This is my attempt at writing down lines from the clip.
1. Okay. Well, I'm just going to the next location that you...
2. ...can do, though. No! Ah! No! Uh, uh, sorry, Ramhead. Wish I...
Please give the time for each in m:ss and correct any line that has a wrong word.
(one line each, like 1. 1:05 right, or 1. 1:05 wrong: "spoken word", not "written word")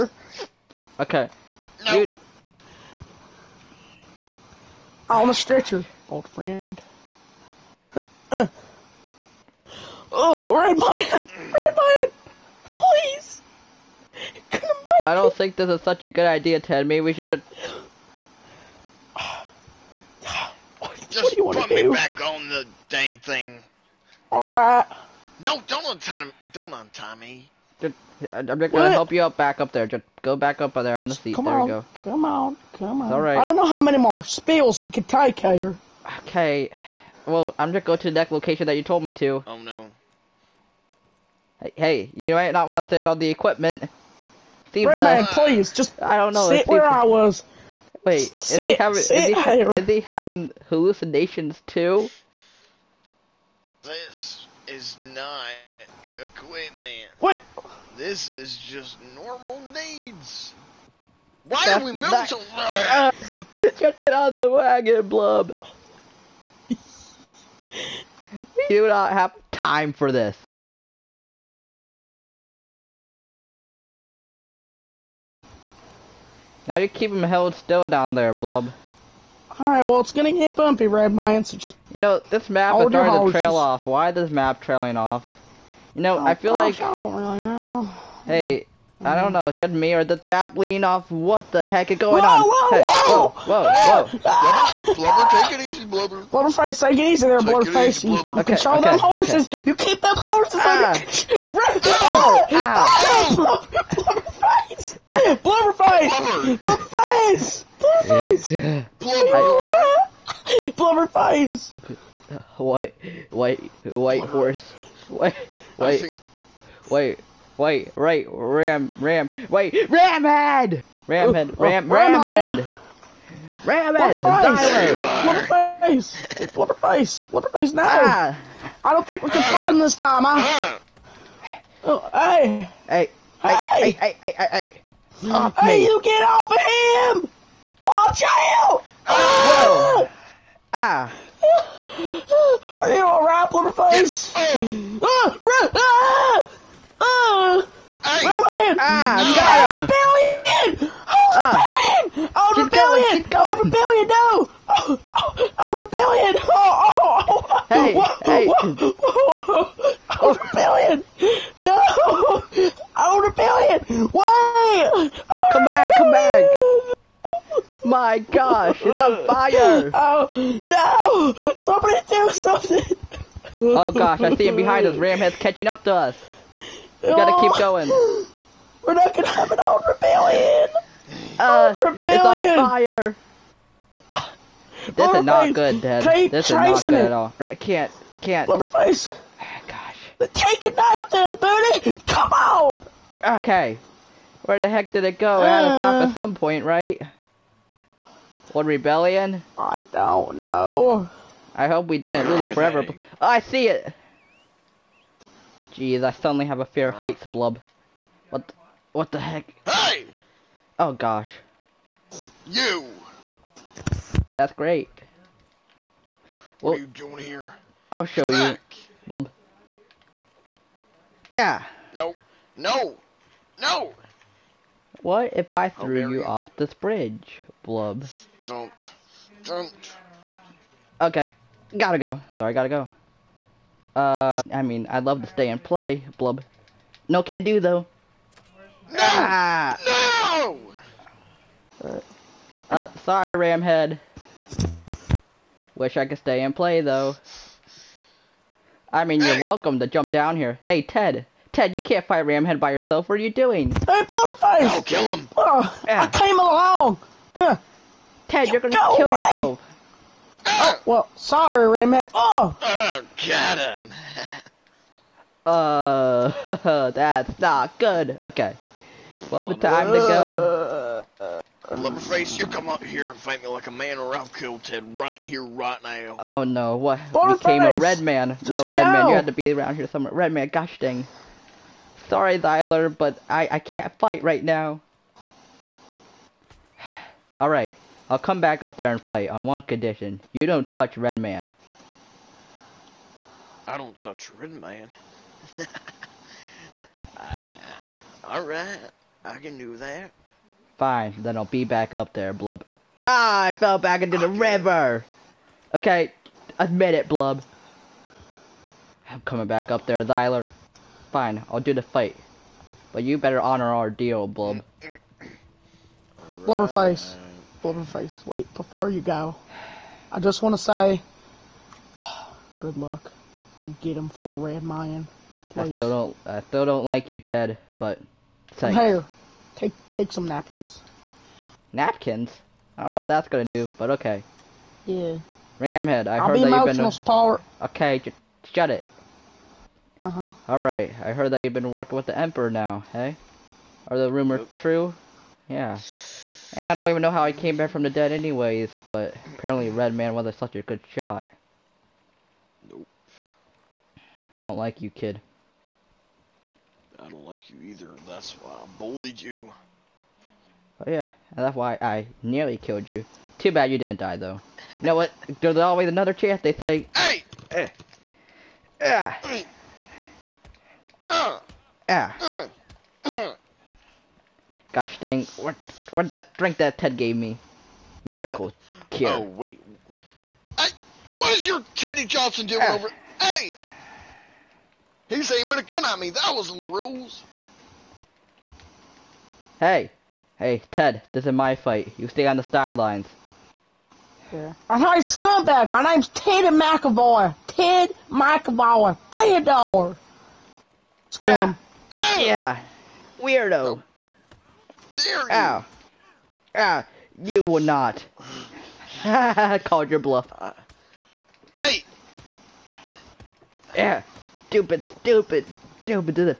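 1. 0:36 right
2. 3:57 right.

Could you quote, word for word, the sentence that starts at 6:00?
Oh, yeah, that's why I nearly killed you.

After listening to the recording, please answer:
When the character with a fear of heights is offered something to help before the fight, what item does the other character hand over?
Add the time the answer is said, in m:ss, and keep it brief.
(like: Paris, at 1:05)
Napkins, at 5:28.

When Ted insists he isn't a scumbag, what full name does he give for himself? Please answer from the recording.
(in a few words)
Ted McAvoy.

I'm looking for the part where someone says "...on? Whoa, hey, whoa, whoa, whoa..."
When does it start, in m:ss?
1:32.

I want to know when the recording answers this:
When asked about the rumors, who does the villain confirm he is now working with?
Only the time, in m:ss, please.
5:41.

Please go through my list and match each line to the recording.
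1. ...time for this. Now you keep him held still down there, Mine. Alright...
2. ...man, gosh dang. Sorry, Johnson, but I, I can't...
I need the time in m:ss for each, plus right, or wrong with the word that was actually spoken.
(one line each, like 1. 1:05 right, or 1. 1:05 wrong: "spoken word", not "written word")
1. 1:09 wrong: "Blub", not "Mine"
2. 4:40 wrong: "Thyler", not "Johnson".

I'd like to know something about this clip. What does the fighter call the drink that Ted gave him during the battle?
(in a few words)
Miracle cure.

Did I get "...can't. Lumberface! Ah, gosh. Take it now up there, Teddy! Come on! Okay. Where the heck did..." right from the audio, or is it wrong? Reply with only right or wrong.
wrong.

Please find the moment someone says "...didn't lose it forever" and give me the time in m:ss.
3:21.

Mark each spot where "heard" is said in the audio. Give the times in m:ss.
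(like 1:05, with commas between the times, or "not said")
5:36, 5:41.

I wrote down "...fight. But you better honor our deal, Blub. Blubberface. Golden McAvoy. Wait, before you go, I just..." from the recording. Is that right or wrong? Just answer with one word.
wrong.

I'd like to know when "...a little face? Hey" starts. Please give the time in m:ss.
2:23.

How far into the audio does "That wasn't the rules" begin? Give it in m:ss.
6:26.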